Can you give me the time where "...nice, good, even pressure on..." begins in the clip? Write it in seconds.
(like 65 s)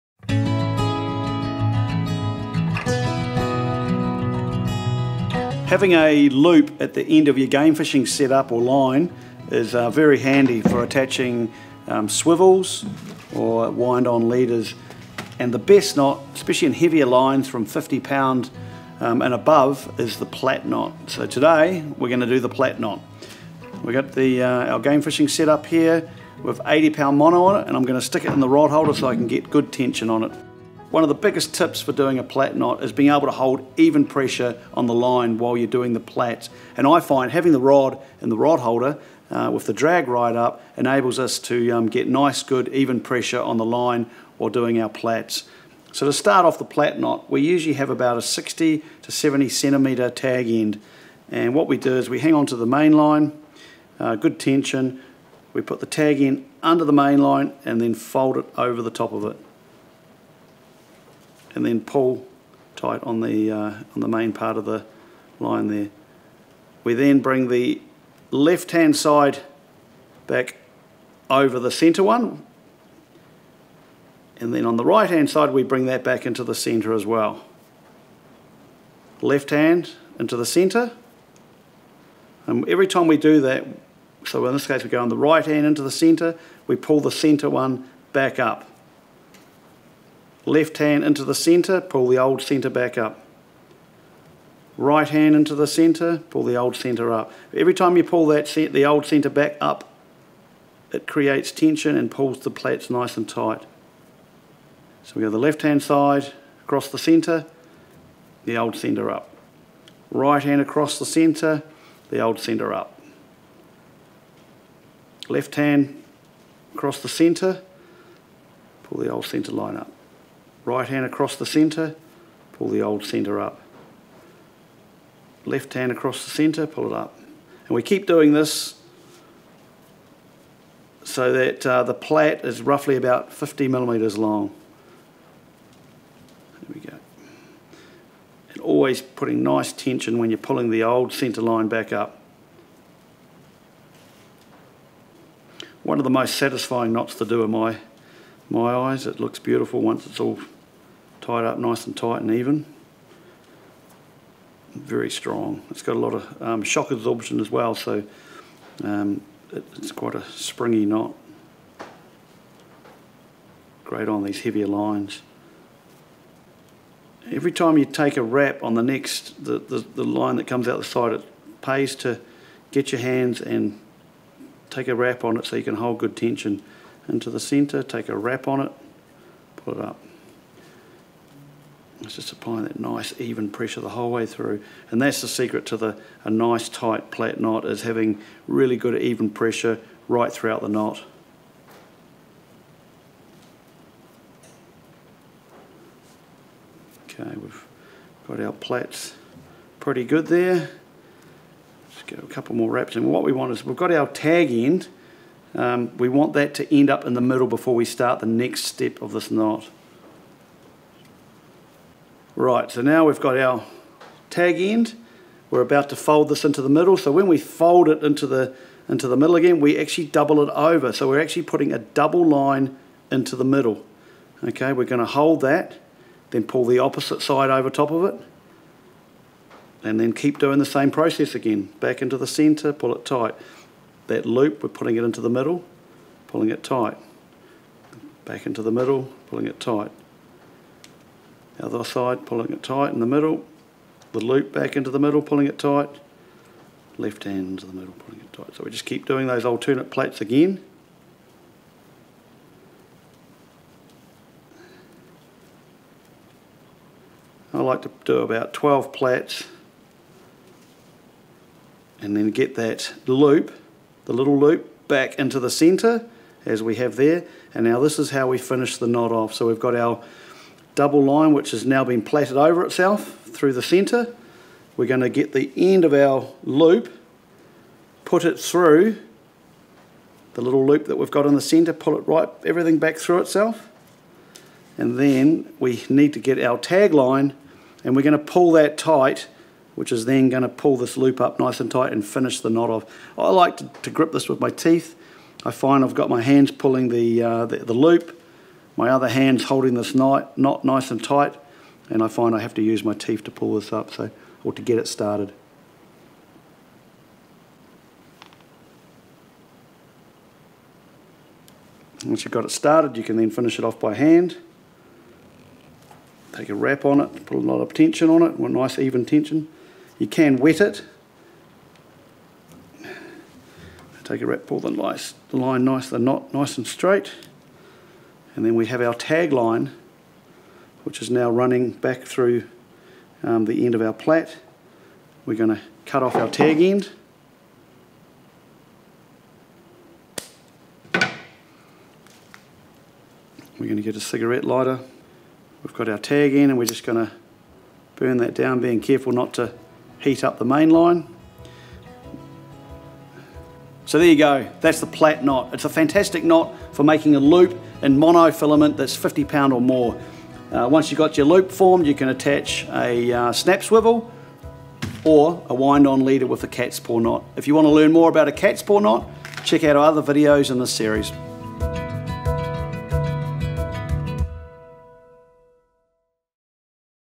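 42 s.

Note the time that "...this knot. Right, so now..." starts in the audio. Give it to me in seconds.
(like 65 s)
209 s.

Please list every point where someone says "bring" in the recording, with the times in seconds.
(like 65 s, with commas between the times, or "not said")
67 s, 75 s.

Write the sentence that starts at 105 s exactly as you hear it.
So we go the left hand side across the centre, the old centre up.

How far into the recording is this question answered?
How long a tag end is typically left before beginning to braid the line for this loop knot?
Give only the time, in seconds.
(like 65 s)
48 s.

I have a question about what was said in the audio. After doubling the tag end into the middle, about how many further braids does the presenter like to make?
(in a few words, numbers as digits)
12.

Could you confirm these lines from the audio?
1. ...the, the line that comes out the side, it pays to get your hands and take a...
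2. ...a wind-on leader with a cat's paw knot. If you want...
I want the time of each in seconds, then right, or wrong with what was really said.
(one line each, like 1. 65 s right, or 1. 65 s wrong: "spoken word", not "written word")
1. 169 s right
2. 365 s right.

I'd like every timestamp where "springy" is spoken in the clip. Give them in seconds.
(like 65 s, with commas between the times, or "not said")
160 s.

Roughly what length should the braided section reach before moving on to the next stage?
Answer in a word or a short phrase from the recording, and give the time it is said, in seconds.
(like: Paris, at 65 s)
50 millimetres, at 133 s.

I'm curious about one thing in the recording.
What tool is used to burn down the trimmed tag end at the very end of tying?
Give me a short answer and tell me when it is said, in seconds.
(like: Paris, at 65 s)
Cigarette lighter, at 344 s.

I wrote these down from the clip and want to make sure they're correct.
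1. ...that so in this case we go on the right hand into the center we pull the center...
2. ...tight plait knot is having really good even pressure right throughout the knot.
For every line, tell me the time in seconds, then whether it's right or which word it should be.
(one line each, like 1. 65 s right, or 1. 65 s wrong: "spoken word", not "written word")
1. 83 s right
2. 186 s right.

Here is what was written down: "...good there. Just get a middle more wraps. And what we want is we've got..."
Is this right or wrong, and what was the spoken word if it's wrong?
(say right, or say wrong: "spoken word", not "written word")
wrong: "couple", not "middle".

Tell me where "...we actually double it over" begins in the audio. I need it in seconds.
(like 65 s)
219 s.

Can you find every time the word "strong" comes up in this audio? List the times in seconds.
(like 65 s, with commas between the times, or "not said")
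155 s.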